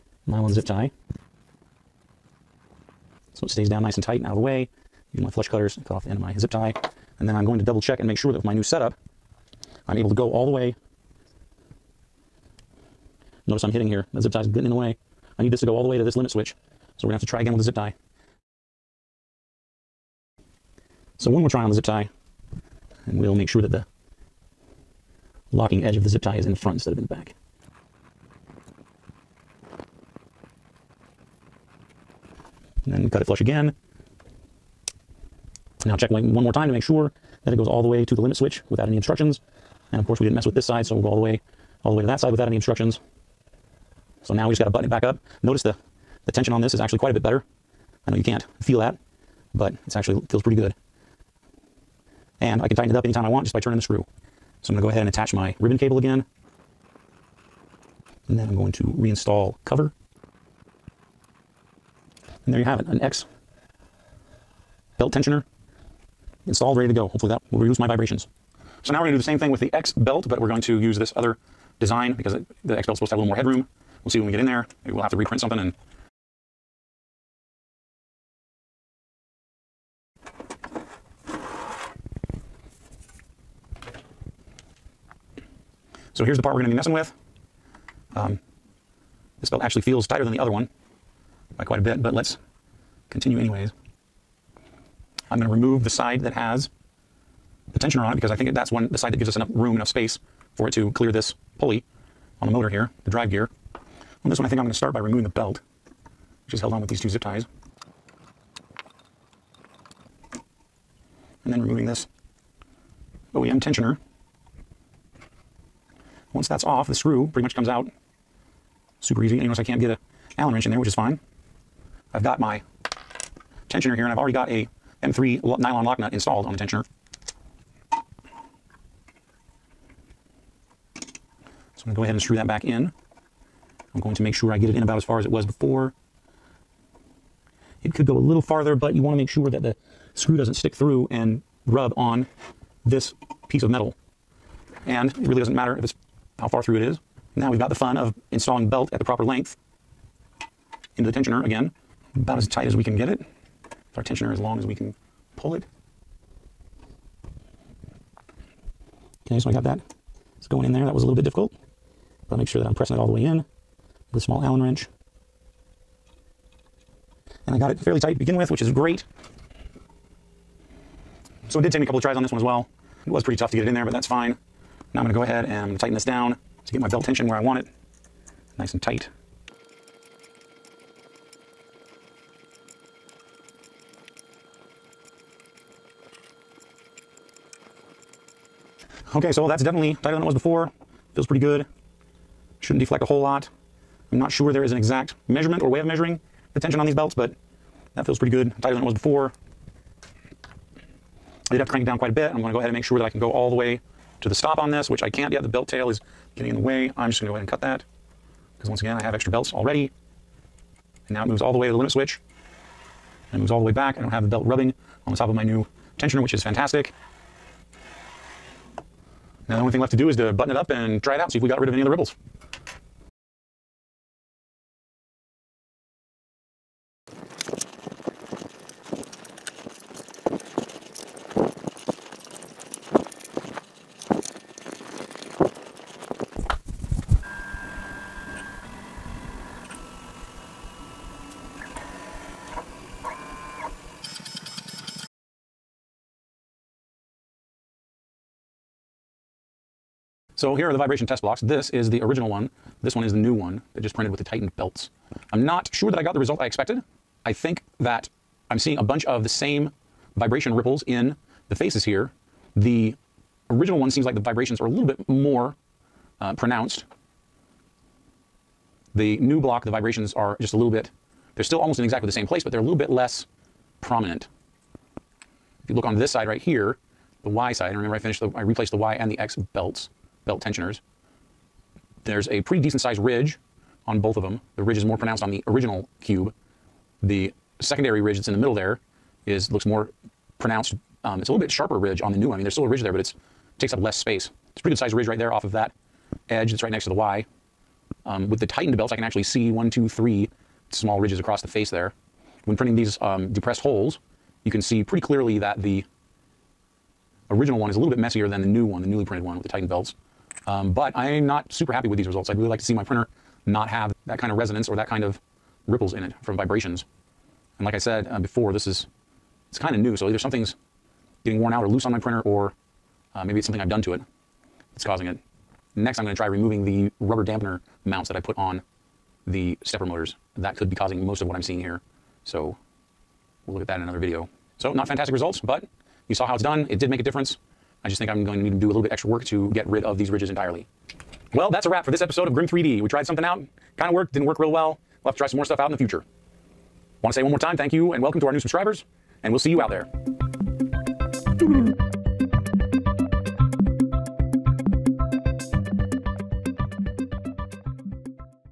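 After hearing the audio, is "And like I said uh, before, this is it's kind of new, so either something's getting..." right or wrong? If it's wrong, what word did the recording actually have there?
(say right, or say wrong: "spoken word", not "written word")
right.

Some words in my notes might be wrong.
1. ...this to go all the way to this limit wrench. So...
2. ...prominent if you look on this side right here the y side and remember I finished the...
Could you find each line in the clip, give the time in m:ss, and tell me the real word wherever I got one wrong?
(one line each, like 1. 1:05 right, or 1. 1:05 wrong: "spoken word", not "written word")
1. 0:15 wrong: "switch", not "wrench"
2. 4:33 right.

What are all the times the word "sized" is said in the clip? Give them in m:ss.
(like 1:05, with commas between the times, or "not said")
4:42, 4:54.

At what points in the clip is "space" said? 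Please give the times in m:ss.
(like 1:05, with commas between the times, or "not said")
1:39, 4:53.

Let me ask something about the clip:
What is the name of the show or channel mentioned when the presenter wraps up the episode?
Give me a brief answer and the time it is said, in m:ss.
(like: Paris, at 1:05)
Grimm 3D, at 5:42.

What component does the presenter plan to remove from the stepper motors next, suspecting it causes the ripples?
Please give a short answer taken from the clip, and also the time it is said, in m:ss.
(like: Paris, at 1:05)
rubber dampener mounts, at 5:27.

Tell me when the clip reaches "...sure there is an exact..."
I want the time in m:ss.
3:14.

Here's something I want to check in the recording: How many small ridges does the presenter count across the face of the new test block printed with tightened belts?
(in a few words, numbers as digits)
3.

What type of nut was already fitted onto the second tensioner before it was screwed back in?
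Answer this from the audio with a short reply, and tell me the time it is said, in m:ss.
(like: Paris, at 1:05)
M3 nylon lock nut, at 2:05.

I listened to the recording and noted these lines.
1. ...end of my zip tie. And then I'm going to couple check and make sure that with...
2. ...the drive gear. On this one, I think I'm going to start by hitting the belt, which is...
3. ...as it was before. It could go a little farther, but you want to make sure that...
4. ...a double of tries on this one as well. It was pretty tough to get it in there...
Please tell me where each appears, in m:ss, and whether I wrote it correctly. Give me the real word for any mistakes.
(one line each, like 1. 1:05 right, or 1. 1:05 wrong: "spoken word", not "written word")
1. 0:06 wrong: "double", not "couple"
2. 1:43 wrong: "removing", not "hitting"
3. 2:15 right
4. 2:51 wrong: "couple", not "double".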